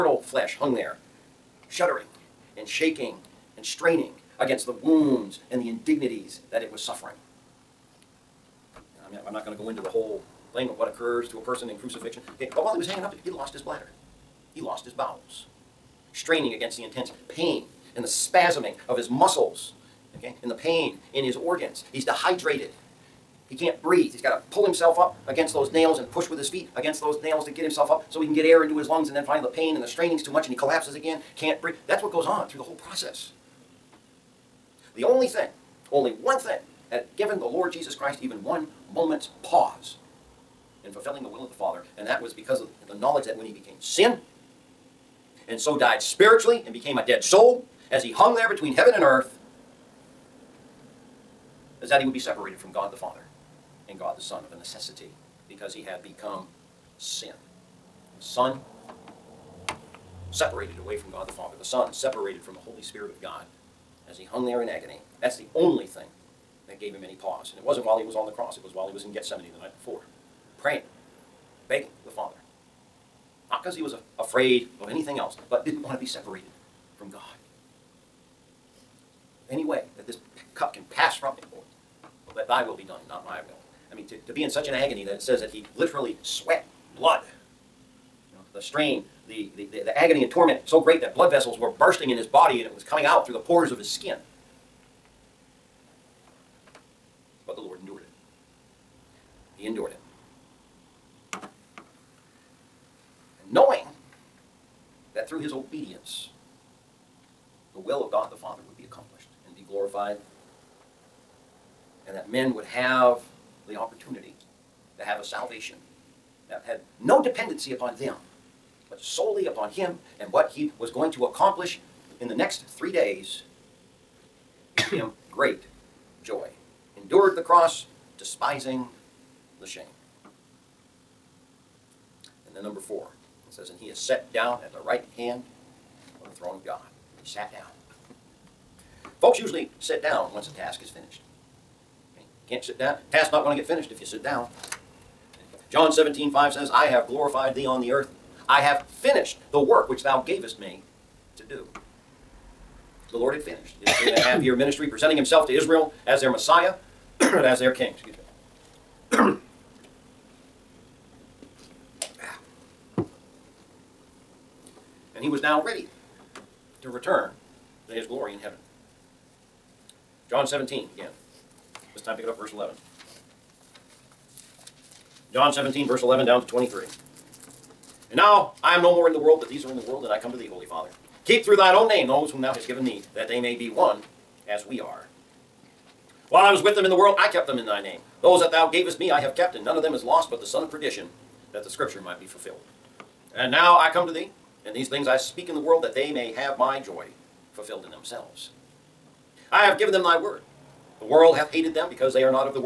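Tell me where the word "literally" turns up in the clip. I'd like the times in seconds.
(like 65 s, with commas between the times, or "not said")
85 s.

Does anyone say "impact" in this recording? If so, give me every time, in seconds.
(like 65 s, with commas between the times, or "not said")
not said.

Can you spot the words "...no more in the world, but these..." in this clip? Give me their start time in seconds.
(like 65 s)
178 s.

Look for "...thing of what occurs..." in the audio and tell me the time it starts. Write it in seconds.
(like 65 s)
10 s.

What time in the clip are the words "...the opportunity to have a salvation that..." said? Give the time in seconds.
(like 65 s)
113 s.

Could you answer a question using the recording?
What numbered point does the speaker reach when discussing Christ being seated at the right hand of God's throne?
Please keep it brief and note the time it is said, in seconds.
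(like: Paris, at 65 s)
4, at 132 s.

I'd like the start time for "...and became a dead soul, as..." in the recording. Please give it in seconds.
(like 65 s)
46 s.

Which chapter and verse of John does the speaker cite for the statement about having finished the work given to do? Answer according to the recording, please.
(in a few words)
John 17:5.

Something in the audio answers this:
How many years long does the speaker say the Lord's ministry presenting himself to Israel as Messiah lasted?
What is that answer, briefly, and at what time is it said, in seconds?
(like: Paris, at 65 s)
3 and a half, at 153 s.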